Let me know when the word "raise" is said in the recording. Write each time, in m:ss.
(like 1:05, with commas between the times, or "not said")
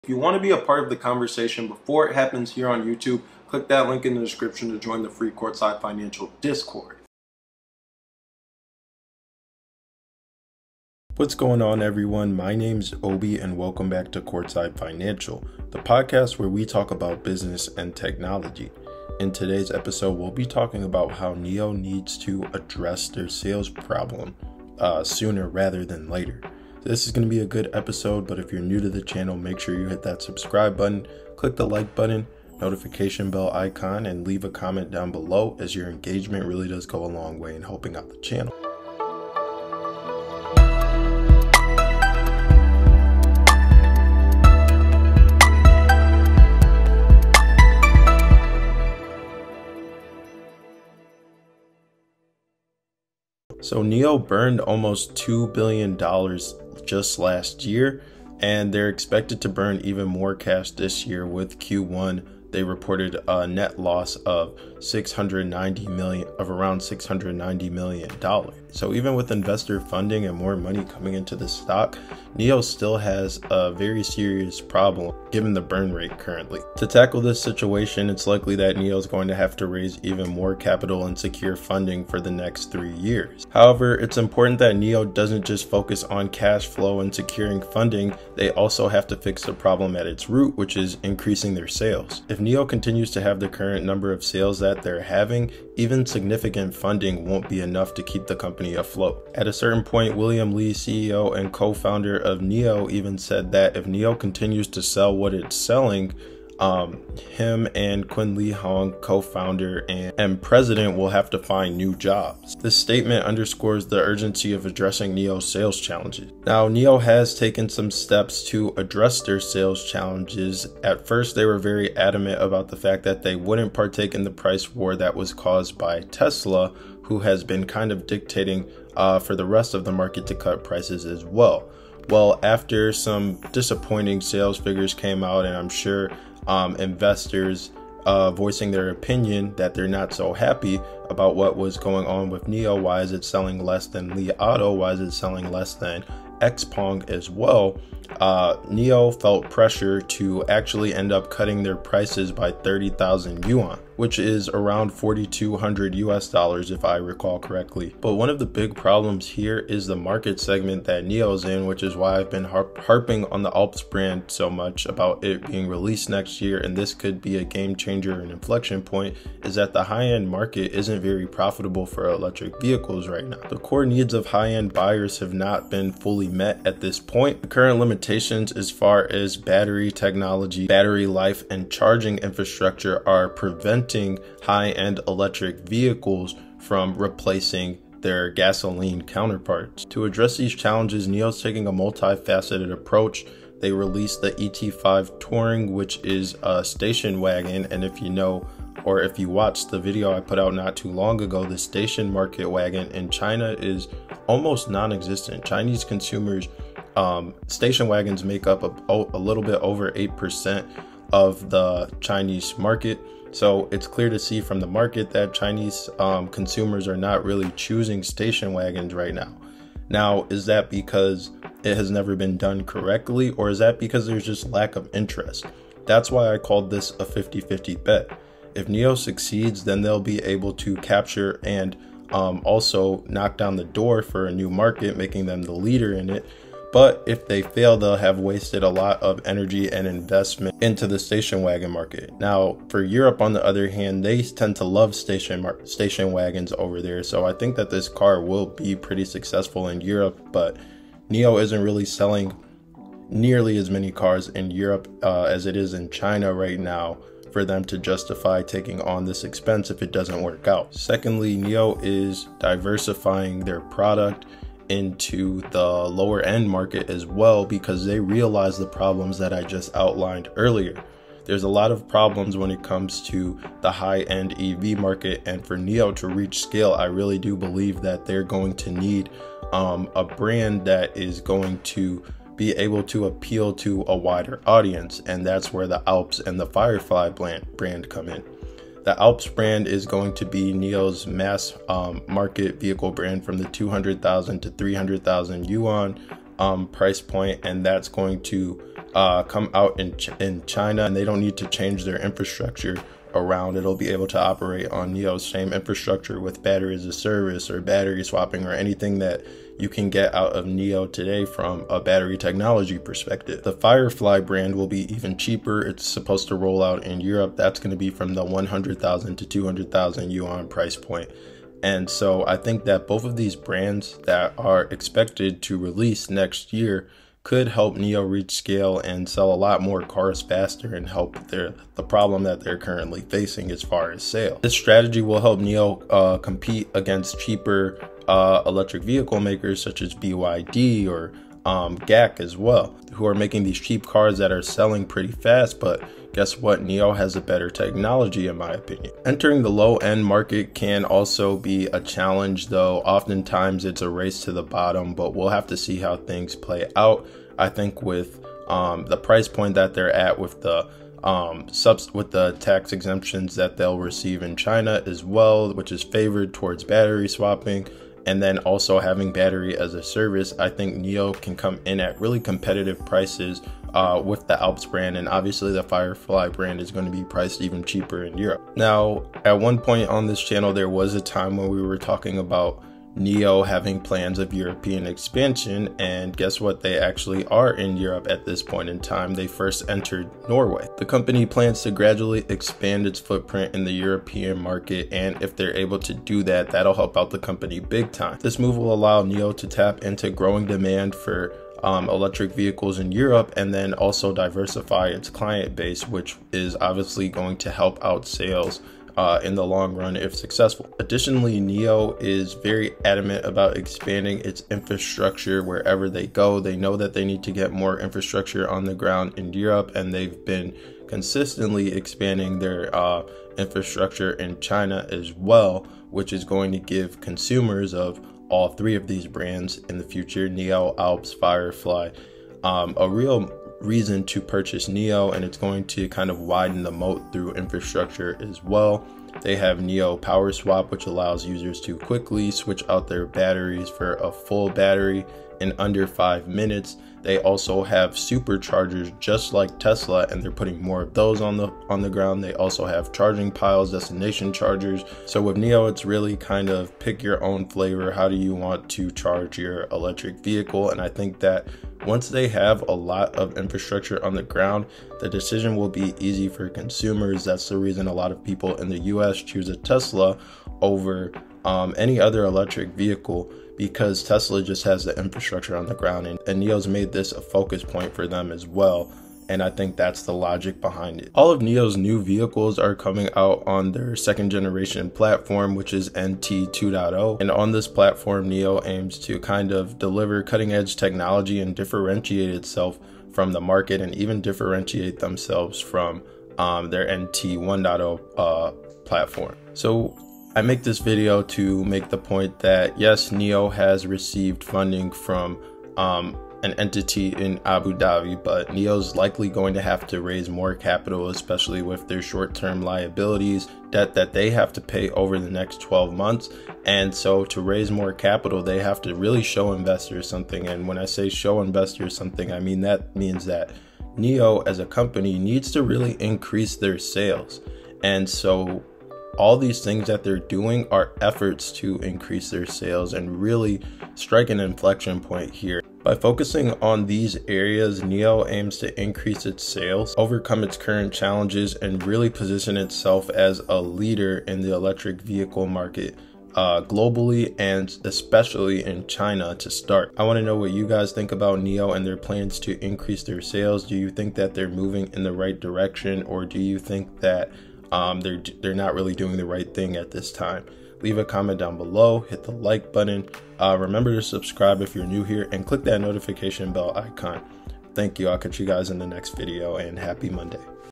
1:19, 8:30, 8:37.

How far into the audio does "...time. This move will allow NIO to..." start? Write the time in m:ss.
6:37.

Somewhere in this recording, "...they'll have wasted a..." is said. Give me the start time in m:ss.
3:57.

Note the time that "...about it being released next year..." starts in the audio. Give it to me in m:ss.
2:44.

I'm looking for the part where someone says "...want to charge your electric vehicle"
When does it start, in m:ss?
7:38.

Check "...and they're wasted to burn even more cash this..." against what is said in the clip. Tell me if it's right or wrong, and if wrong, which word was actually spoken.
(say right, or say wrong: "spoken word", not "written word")
wrong: "expected", not "wasted".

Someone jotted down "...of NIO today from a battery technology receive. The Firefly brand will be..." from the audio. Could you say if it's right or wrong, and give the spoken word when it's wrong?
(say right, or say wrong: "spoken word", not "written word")
wrong: "perspective", not "receive".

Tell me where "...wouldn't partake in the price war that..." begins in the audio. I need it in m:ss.
2:03.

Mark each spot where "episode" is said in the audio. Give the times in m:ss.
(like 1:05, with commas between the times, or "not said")
0:19, 0:27.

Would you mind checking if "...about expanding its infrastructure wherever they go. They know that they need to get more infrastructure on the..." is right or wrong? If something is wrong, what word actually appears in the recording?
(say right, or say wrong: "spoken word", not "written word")
right.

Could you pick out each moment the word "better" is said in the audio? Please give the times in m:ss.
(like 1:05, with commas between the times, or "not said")
5:47.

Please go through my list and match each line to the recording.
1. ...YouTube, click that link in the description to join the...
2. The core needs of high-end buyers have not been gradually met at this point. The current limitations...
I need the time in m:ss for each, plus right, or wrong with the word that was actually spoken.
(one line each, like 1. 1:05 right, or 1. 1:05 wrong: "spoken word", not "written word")
1. 0:02 right
2. 2:53 wrong: "fully", not "gradually".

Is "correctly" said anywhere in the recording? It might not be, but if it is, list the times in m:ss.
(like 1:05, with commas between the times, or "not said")
2:37, 3:42.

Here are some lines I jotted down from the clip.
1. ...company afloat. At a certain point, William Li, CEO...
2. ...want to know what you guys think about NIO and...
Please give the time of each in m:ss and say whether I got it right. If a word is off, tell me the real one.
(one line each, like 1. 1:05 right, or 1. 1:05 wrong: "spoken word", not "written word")
1. 1:38 right
2. 9:10 right.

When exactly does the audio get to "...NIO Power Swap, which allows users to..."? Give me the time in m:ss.
7:19.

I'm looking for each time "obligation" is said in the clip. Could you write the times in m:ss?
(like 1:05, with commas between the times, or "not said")
not said.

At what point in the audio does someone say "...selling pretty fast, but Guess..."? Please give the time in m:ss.
5:44.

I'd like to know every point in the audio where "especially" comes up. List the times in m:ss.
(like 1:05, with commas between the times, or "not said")
8:31, 9:07.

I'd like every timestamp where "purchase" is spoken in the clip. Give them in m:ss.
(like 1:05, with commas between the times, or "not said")
7:14.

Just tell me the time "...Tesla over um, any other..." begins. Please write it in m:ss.
7:49.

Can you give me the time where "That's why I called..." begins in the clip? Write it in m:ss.
3:45.